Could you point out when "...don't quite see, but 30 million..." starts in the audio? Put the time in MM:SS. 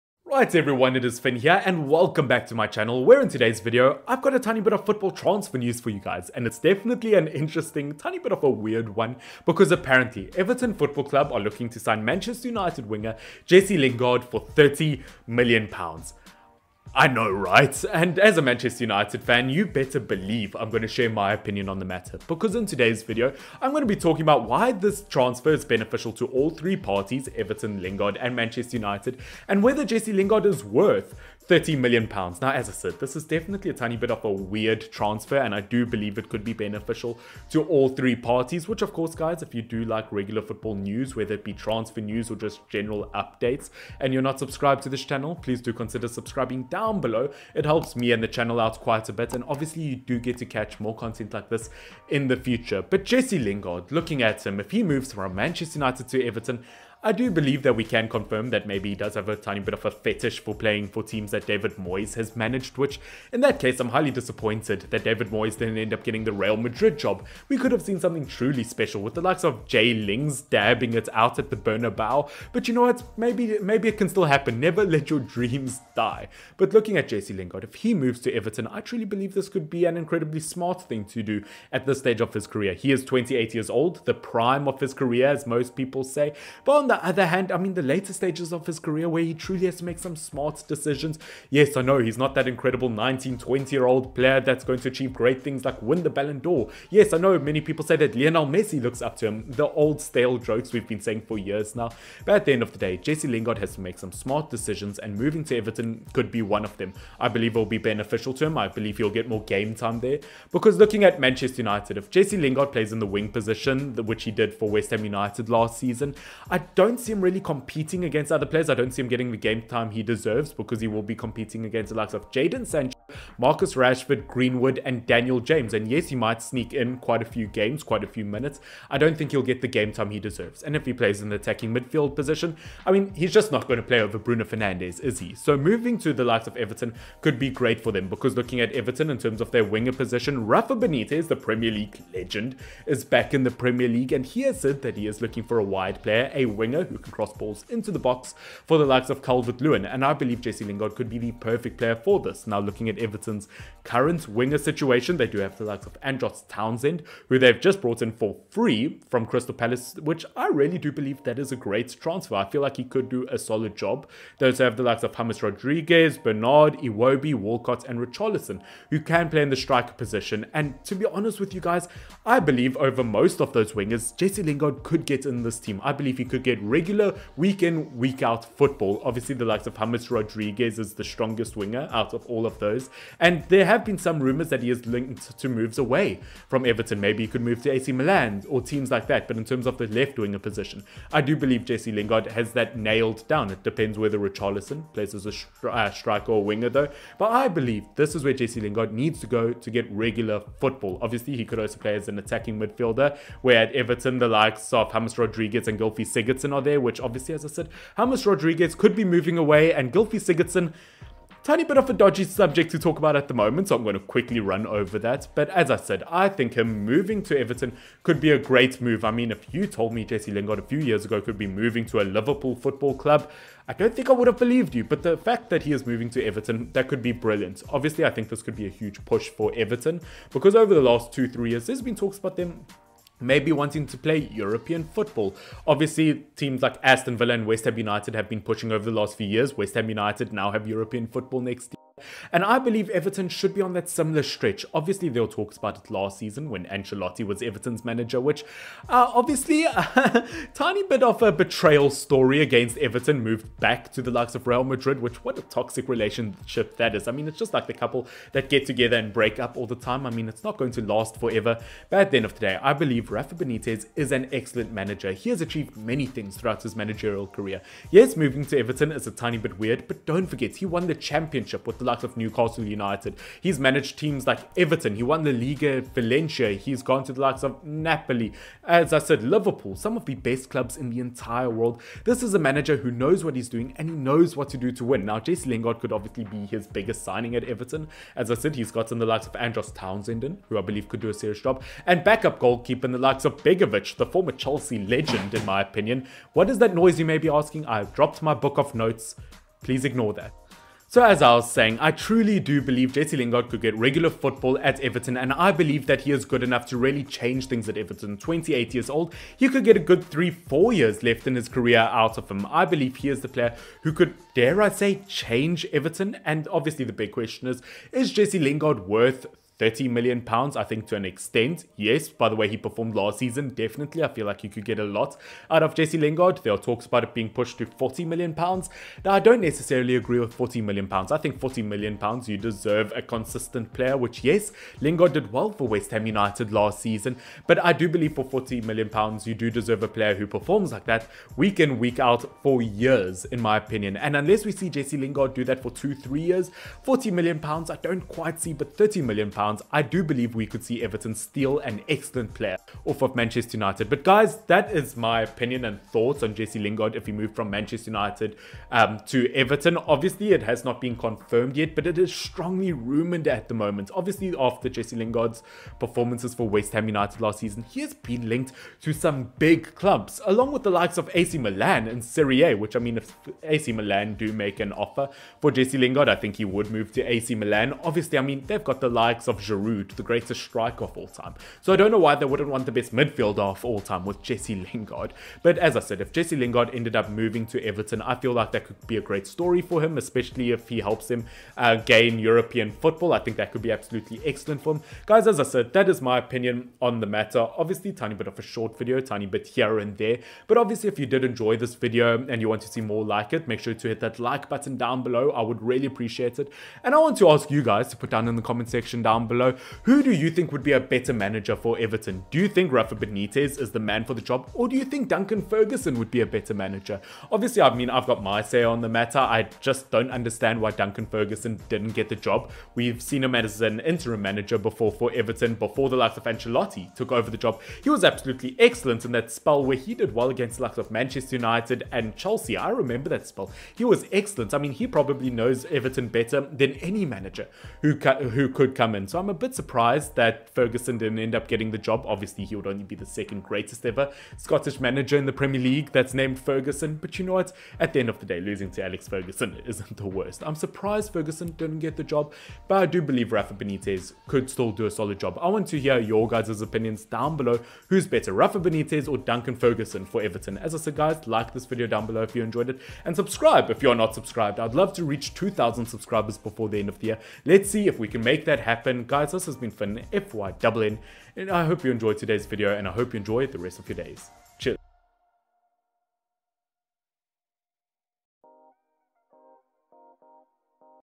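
05:47.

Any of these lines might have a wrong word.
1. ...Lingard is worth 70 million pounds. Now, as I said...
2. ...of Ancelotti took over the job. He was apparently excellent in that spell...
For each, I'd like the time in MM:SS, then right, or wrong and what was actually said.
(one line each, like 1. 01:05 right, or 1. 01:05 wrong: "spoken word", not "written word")
1. 00:30 wrong: "30", not "70"
2. 07:06 wrong: "absolutely", not "apparently".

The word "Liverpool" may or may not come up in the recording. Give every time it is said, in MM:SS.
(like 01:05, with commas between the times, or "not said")
03:42, 04:39.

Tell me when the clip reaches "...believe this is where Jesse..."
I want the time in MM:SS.
03:17.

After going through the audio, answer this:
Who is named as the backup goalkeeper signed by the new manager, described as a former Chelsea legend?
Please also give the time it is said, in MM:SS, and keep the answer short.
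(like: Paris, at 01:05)
Begovic, at 04:53.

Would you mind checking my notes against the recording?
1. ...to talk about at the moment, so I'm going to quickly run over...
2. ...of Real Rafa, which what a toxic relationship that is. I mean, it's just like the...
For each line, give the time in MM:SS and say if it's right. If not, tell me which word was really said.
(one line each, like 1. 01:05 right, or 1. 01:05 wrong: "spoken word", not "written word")
1. 03:32 right
2. 04:14 wrong: "Madrid", not "Rafa".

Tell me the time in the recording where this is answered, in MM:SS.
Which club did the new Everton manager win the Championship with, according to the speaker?
04:32.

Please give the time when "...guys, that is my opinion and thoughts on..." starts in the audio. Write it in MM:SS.
05:54.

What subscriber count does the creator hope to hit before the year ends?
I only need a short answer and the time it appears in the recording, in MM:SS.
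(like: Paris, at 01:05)
2,000, at 07:45.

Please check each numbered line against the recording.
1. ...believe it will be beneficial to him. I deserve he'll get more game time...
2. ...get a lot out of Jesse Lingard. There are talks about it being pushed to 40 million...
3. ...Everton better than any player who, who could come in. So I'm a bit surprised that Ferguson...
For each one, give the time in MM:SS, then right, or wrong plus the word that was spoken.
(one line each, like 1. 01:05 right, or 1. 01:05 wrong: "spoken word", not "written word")
1. 01:47 wrong: "believe", not "deserve"
2. 05:24 right
3. 07:15 wrong: "manager", not "player".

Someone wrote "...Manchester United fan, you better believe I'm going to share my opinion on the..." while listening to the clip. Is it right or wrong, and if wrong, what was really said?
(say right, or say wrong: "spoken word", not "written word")
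right.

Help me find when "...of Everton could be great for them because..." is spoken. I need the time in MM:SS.
02:16.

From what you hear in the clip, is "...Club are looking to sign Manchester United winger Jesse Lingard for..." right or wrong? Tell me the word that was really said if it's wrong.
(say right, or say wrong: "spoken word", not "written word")
right.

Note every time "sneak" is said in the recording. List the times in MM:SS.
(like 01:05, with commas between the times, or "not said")
02:06.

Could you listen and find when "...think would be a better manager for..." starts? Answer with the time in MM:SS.
06:50.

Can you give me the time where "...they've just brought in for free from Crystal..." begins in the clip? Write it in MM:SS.
02:37.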